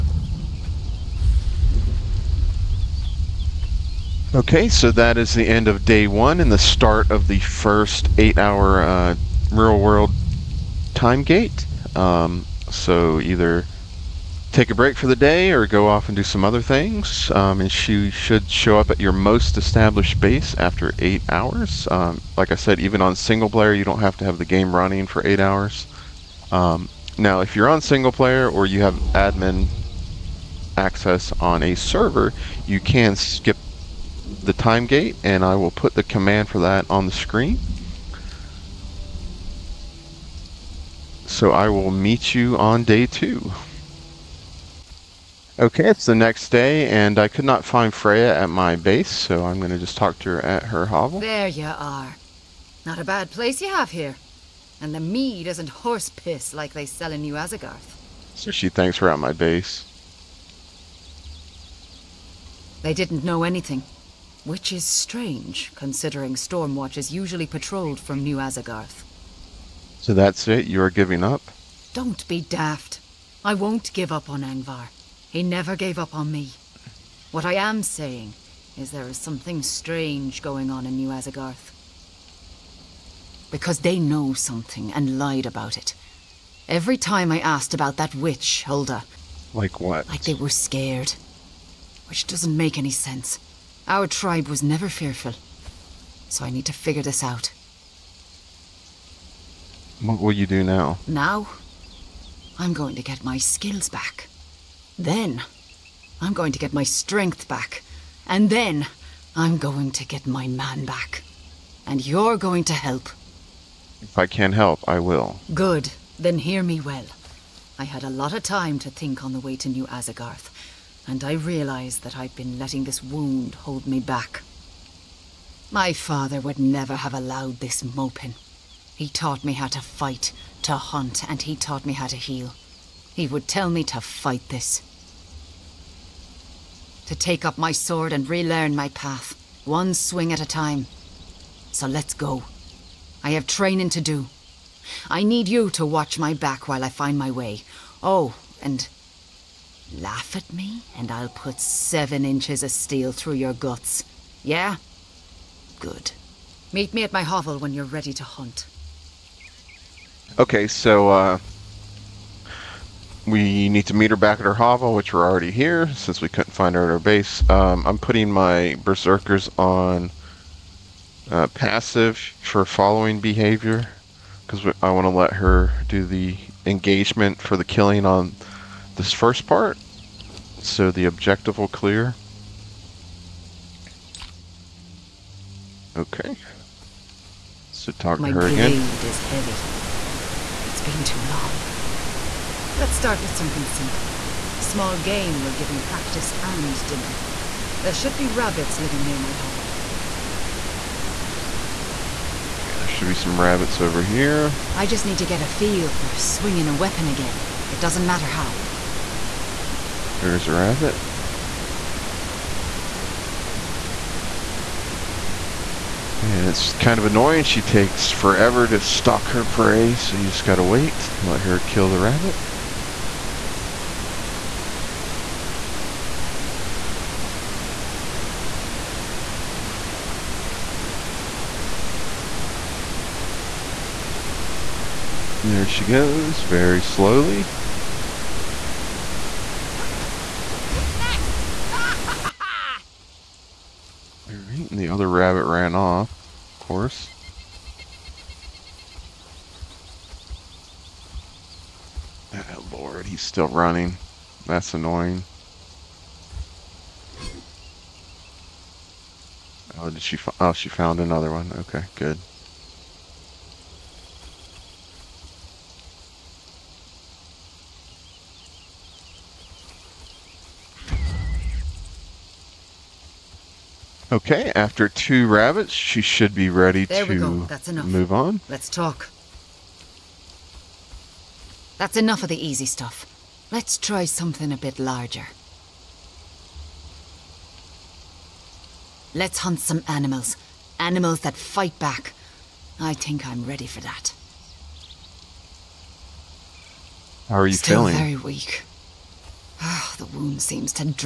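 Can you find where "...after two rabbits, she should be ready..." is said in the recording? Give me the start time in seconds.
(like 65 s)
274 s.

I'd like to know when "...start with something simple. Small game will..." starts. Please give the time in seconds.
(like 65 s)
192 s.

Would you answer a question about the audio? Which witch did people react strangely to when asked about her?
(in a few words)
Hulda.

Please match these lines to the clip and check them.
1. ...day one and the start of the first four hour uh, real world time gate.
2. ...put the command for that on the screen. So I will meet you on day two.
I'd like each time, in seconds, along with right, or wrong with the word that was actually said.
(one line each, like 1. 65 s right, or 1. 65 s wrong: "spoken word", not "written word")
1. 5 s wrong: "eight", not "four"
2. 35 s right.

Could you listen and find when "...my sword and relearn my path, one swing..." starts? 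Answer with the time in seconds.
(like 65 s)
137 s.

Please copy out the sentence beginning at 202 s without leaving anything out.
Okay, there should be some rabbits over here.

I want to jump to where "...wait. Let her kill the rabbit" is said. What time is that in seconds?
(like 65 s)
220 s.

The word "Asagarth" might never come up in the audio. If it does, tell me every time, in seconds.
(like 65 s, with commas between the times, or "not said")
57 s, 68 s, 81 s, 119 s.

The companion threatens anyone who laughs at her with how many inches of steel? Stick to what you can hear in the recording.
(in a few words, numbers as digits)
7.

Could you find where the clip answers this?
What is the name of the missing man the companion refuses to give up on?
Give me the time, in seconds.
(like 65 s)
74 s.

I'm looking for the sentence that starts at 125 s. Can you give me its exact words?
My father would never have allowed this moping.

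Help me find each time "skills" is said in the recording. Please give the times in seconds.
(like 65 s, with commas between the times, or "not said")
103 s.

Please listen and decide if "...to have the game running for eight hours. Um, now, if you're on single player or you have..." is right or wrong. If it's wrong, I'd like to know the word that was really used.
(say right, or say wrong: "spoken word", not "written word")
right.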